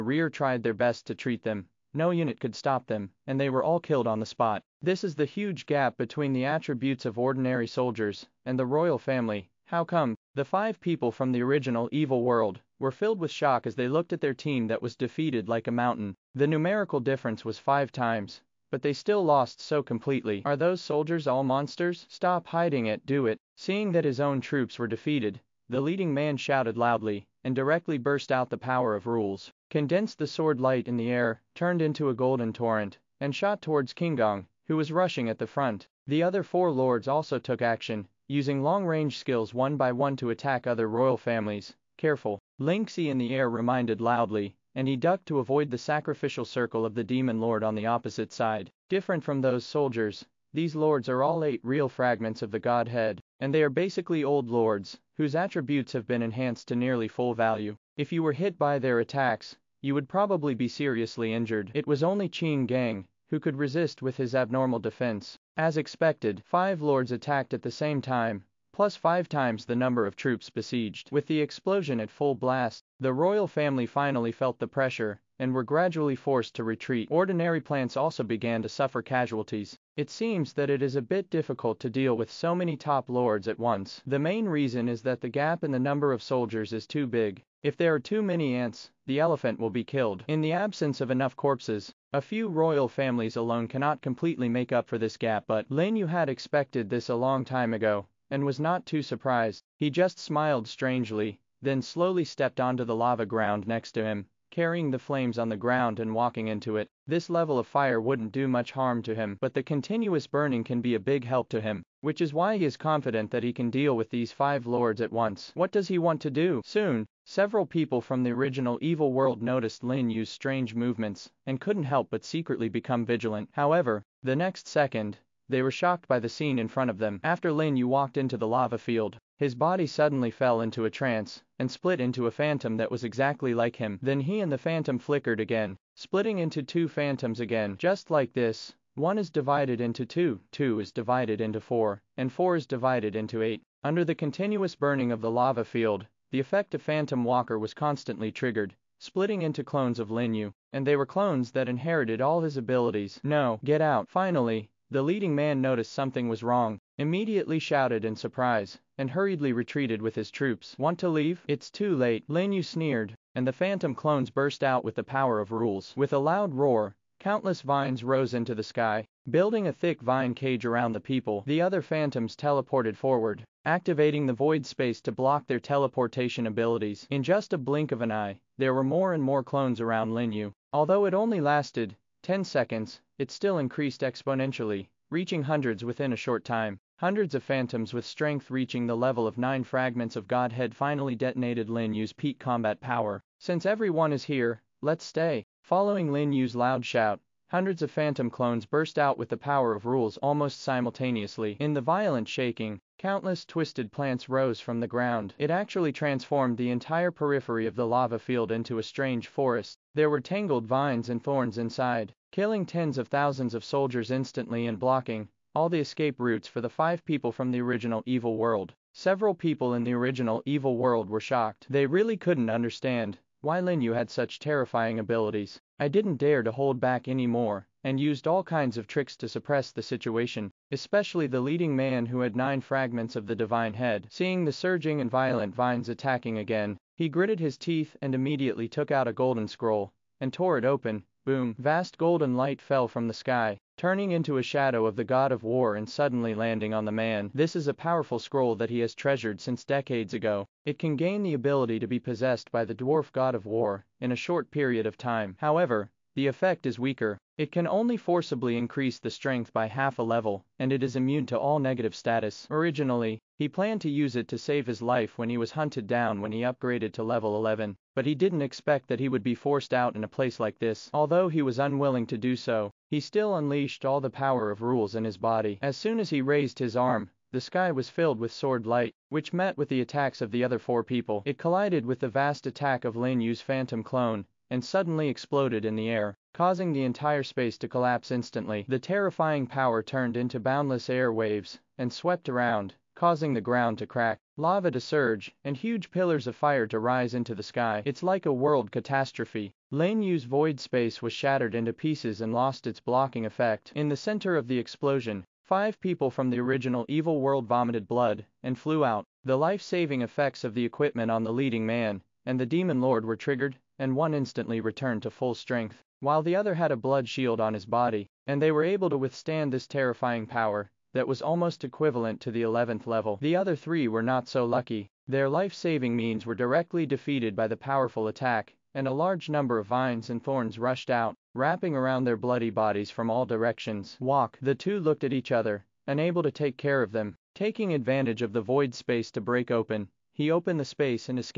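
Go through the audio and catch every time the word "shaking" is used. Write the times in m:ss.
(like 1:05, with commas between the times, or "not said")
3:22.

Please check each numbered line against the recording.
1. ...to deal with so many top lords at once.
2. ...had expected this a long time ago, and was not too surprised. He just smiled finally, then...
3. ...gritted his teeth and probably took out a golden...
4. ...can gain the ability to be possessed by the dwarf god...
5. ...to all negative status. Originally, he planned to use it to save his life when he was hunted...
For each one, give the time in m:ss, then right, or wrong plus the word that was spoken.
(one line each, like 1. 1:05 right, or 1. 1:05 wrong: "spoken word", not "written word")
1. 1:21 right
2. 1:36 wrong: "strangely", not "finally"
3. 3:57 wrong: "immediately", not "probably"
4. 4:10 right
5. 4:21 right.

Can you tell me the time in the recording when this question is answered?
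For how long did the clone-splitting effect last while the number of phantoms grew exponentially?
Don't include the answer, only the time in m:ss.
3:02.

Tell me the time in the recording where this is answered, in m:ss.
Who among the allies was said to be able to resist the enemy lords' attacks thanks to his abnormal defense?
1:02.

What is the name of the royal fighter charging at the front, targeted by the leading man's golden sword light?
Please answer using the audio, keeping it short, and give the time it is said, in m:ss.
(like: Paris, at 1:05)
Kingong, at 0:33.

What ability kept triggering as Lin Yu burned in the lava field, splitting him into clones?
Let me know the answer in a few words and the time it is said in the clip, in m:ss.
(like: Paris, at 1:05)
Phantom Walker, at 2:26.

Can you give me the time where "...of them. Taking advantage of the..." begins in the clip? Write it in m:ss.
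5:36.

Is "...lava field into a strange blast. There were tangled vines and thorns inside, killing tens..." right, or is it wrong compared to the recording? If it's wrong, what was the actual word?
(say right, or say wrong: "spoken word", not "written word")
wrong: "forest", not "blast".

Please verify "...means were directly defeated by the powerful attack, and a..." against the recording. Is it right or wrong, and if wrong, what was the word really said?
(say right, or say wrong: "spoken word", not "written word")
right.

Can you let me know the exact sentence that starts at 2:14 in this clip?
Then he and the phantom flickered again, splitting into two phantoms again.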